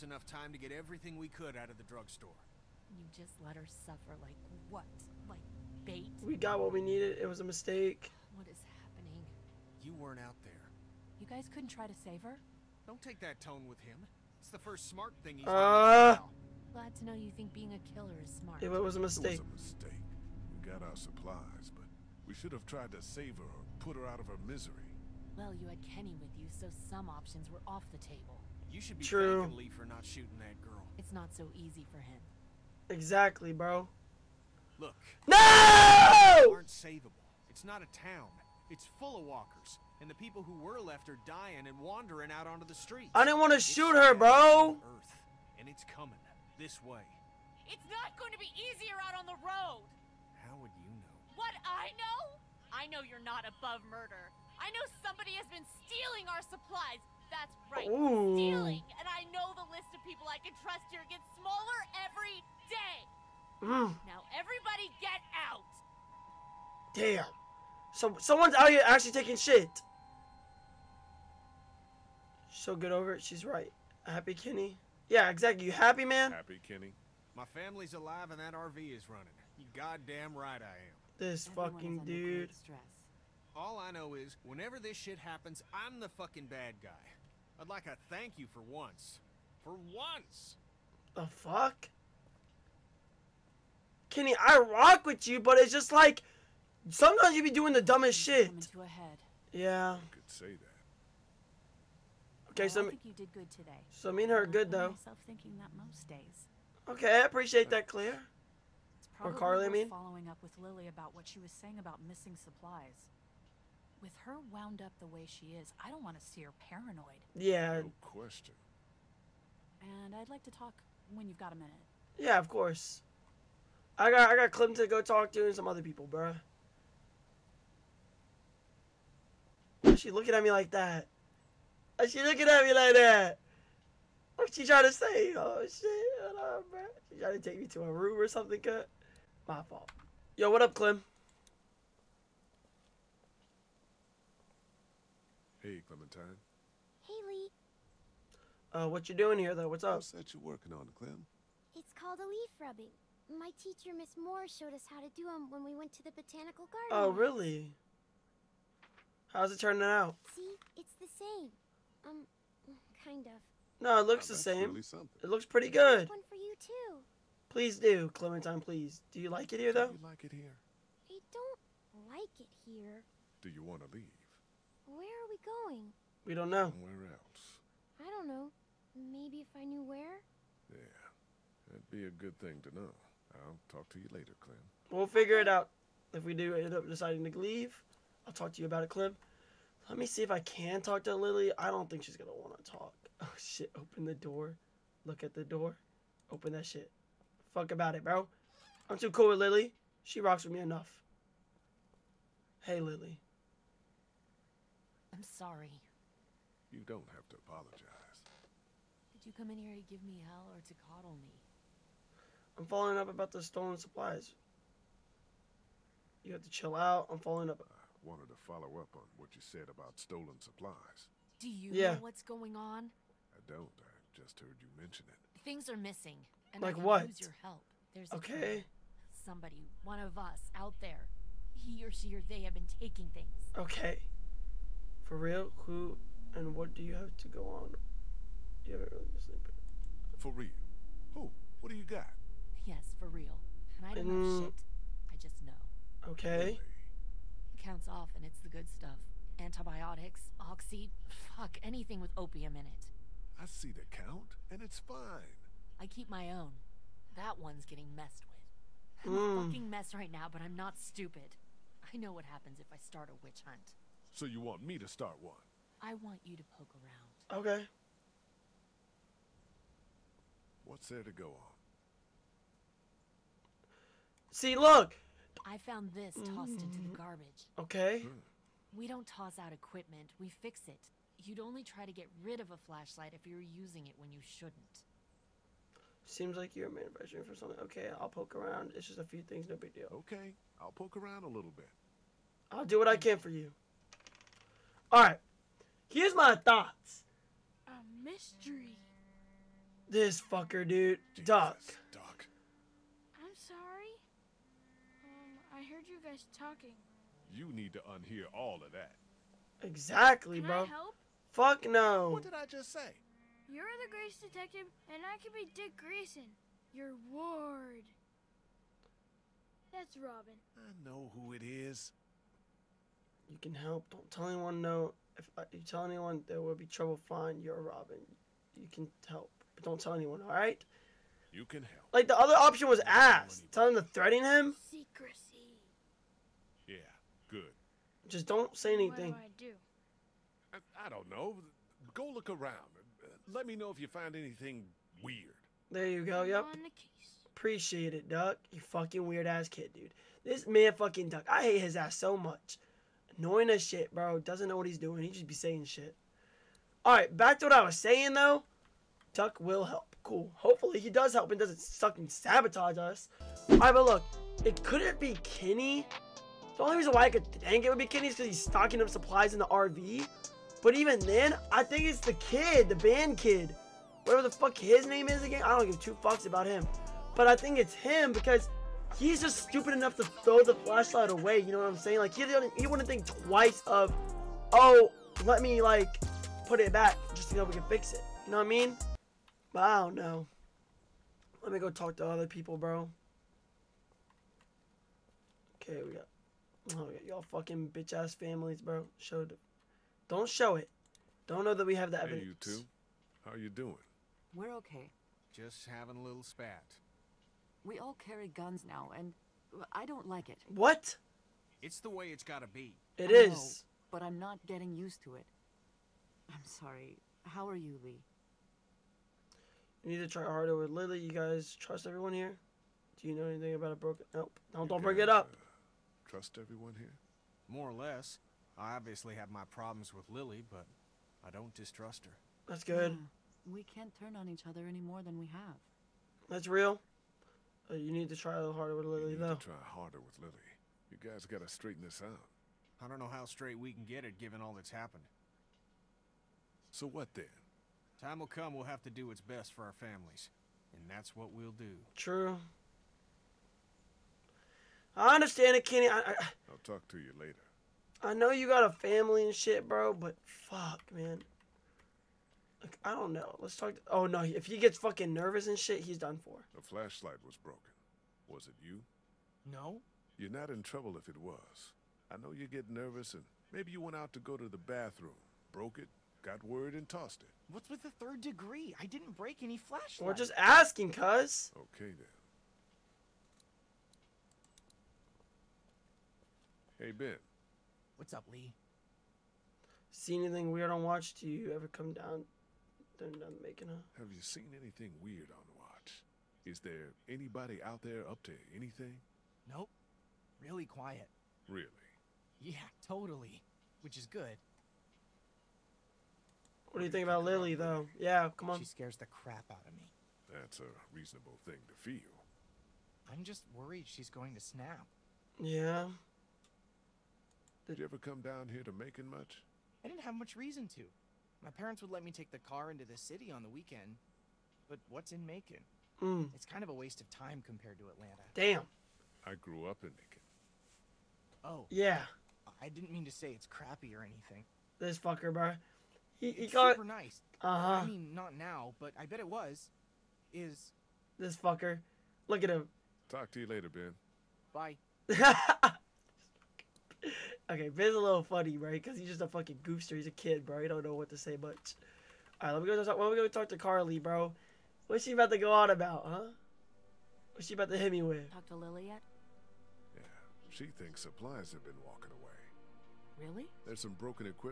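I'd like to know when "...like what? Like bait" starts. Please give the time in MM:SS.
00:04.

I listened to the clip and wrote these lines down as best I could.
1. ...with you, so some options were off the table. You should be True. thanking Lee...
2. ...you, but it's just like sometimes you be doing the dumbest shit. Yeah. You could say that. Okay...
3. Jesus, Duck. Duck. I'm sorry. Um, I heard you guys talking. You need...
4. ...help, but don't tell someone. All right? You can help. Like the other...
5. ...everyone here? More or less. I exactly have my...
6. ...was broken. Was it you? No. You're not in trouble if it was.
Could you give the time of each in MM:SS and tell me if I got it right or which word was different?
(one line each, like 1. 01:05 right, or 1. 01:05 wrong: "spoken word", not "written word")
1. 00:26 right
2. 01:35 right
3. 05:01 right
4. 05:29 wrong: "anyone", not "someone"
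5. 07:06 wrong: "obviously", not "exactly"
6. 07:47 right.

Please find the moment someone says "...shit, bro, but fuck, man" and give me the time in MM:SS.
07:39.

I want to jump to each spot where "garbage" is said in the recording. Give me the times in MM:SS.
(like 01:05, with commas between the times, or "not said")
04:36.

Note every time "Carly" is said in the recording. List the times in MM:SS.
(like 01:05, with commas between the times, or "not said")
01:49, 09:13.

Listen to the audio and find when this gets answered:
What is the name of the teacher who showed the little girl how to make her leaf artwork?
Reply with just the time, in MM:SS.
02:33.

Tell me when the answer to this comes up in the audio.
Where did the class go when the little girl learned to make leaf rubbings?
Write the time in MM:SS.
02:36.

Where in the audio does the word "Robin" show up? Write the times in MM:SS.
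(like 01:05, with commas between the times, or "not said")
05:19, 05:27.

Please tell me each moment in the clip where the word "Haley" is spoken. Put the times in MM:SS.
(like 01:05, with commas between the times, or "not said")
02:27.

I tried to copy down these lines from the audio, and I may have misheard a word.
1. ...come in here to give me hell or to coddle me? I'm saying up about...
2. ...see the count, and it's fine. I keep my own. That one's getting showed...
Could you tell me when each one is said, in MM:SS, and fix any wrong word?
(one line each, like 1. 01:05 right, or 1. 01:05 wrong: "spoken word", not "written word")
1. 03:29 wrong: "following", not "saying"
2. 04:13 wrong: "messed", not "showed".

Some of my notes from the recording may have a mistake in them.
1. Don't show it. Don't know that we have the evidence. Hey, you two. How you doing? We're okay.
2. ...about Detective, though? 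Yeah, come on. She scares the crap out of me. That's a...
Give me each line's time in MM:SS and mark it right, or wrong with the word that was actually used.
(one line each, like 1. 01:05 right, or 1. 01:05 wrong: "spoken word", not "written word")
1. 06:40 right
2. 08:27 wrong: "Lily", not "Detective".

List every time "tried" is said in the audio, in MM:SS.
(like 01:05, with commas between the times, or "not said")
00:22.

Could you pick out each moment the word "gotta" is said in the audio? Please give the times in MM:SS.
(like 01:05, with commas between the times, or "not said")
06:52, 07:21.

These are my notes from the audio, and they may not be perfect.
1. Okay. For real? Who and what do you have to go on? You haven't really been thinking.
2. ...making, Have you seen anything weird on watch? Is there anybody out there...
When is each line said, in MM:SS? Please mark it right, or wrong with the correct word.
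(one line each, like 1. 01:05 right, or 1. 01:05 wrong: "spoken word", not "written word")
1. 03:53 wrong: "sleeping", not "thinking"
2. 08:13 right.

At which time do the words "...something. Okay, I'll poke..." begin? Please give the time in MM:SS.
04:47.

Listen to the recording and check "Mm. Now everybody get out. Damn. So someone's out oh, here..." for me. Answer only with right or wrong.
right.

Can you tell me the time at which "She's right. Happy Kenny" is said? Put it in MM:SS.
01:13.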